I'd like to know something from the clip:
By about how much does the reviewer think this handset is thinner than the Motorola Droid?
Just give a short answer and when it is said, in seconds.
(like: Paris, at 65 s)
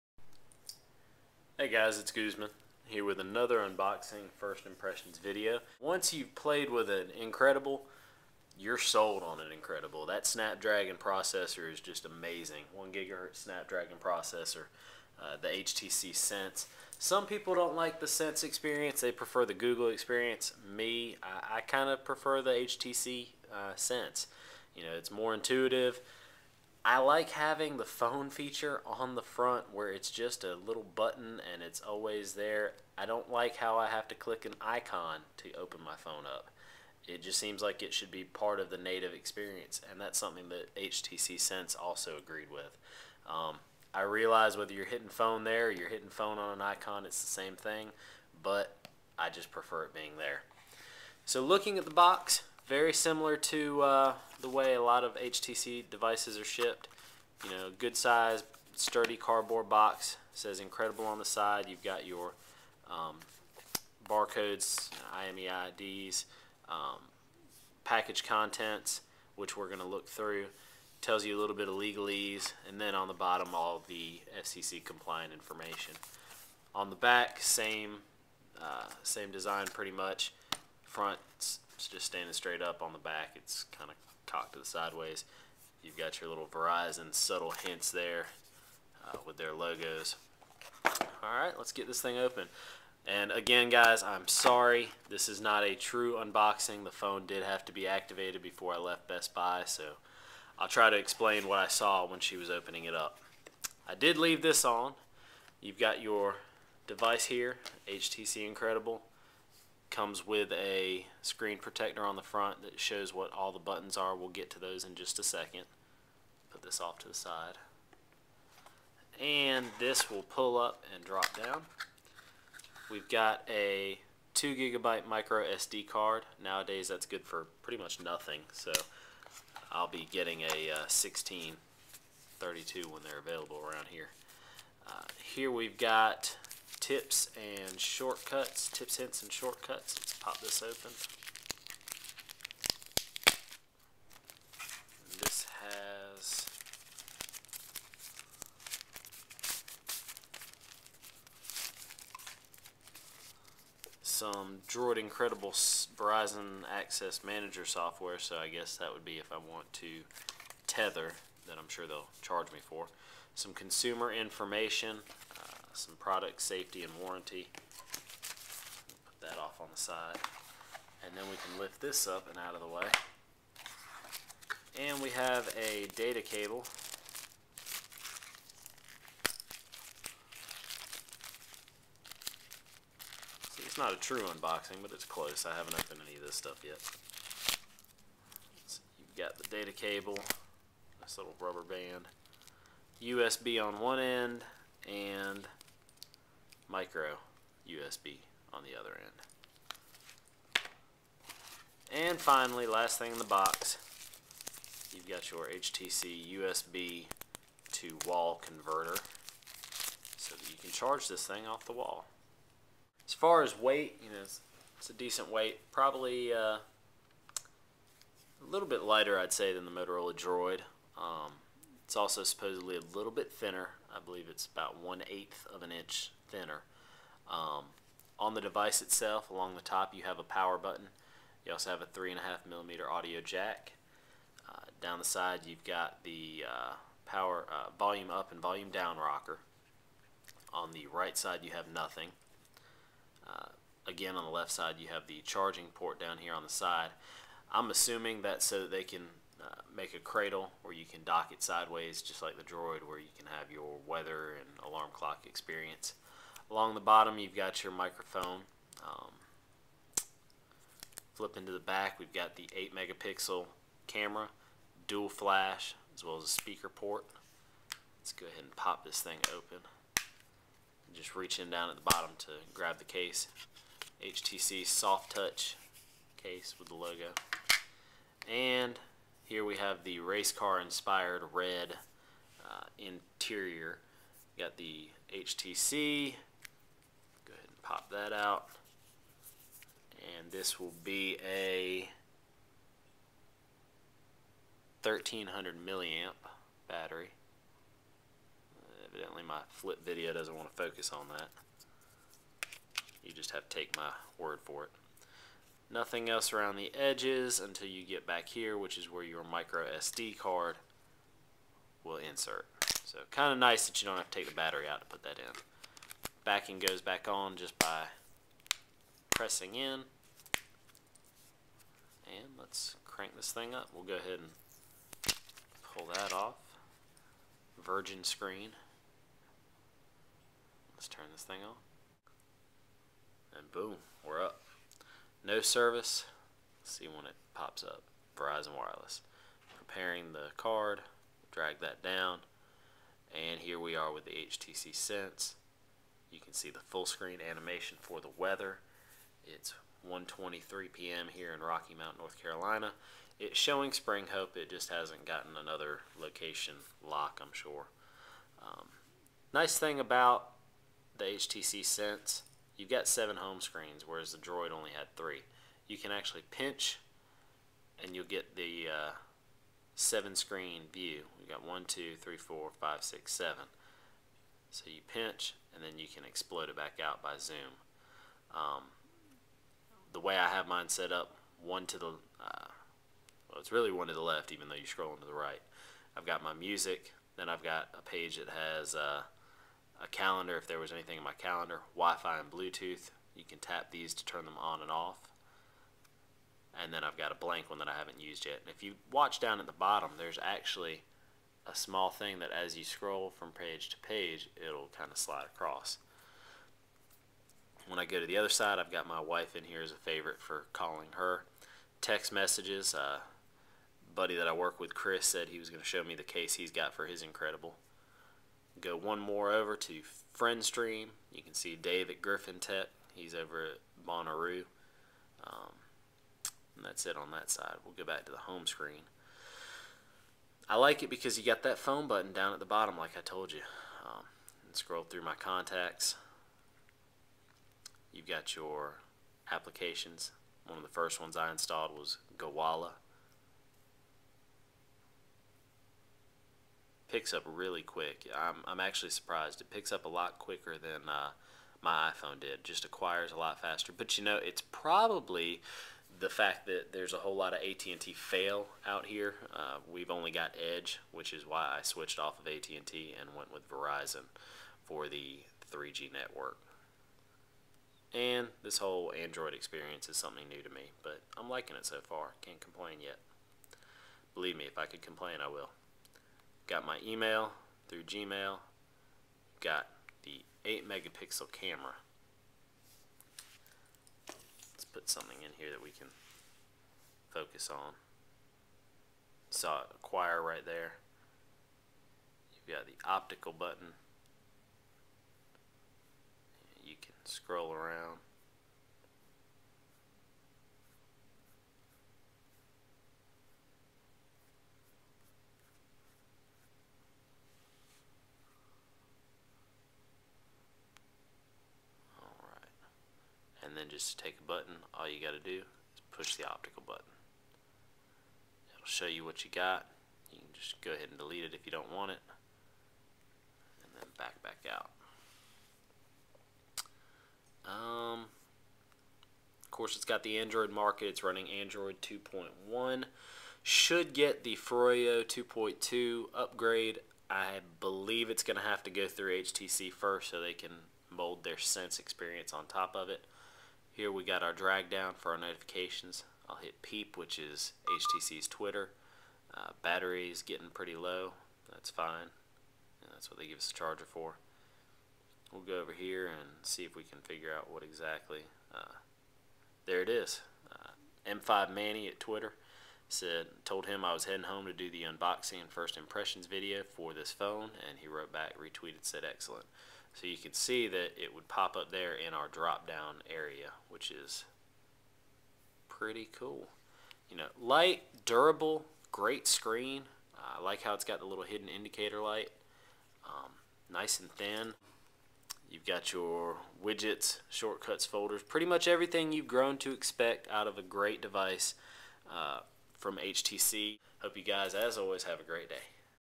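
one eighth of an inch, at 224 s.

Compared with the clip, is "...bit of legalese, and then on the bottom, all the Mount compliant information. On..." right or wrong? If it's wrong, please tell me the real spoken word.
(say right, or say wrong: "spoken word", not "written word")
wrong: "FCC", not "Mount".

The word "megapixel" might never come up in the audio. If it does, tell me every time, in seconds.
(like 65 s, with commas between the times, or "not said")
262 s, 480 s.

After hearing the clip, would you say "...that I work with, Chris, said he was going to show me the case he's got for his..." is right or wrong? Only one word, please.
right.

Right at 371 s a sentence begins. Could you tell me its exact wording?
We got one, two, three, four, five, six, seven.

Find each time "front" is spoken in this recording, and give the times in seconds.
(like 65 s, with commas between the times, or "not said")
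29 s, 80 s, 112 s.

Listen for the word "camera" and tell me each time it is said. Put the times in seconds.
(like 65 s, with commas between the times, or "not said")
263 s, 481 s.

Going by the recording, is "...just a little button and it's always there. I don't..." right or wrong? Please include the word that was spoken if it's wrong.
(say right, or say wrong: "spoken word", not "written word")
right.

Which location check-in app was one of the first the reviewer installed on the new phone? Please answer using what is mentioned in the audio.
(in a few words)
Gowalla.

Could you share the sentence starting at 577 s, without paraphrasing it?
You know, light, durable, great screen.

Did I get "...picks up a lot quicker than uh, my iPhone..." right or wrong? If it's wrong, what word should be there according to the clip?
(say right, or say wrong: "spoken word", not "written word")
right.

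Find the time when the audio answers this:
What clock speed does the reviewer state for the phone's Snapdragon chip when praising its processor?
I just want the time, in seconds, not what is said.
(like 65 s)
12 s.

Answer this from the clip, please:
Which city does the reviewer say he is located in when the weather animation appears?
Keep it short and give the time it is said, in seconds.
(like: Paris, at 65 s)
Rocky Mount, at 351 s.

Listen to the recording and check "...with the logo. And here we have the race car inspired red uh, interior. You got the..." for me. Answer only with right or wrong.
right.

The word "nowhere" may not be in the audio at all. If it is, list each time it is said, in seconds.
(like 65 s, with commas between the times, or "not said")
not said.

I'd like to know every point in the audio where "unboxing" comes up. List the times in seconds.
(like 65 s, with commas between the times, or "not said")
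3 s, 96 s, 184 s, 564 s.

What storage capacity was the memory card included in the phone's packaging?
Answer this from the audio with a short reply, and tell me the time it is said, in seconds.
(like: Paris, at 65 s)
2 gigabyte, at 124 s.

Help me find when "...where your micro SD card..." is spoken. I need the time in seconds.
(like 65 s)
308 s.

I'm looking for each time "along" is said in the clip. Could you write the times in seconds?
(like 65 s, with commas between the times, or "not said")
229 s, 256 s.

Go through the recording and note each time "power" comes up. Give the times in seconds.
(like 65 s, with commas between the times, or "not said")
230 s, 237 s.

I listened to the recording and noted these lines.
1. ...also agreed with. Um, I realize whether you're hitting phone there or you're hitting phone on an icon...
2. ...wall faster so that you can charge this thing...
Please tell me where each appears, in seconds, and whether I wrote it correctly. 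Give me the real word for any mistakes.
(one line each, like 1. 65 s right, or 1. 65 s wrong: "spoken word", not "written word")
1. 41 s right
2. 208 s wrong: "converter", not "faster".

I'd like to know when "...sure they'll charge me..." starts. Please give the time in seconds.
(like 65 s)
161 s.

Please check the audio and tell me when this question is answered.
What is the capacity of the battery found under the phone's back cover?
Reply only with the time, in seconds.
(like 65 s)
294 s.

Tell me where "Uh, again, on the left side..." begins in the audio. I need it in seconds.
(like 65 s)
243 s.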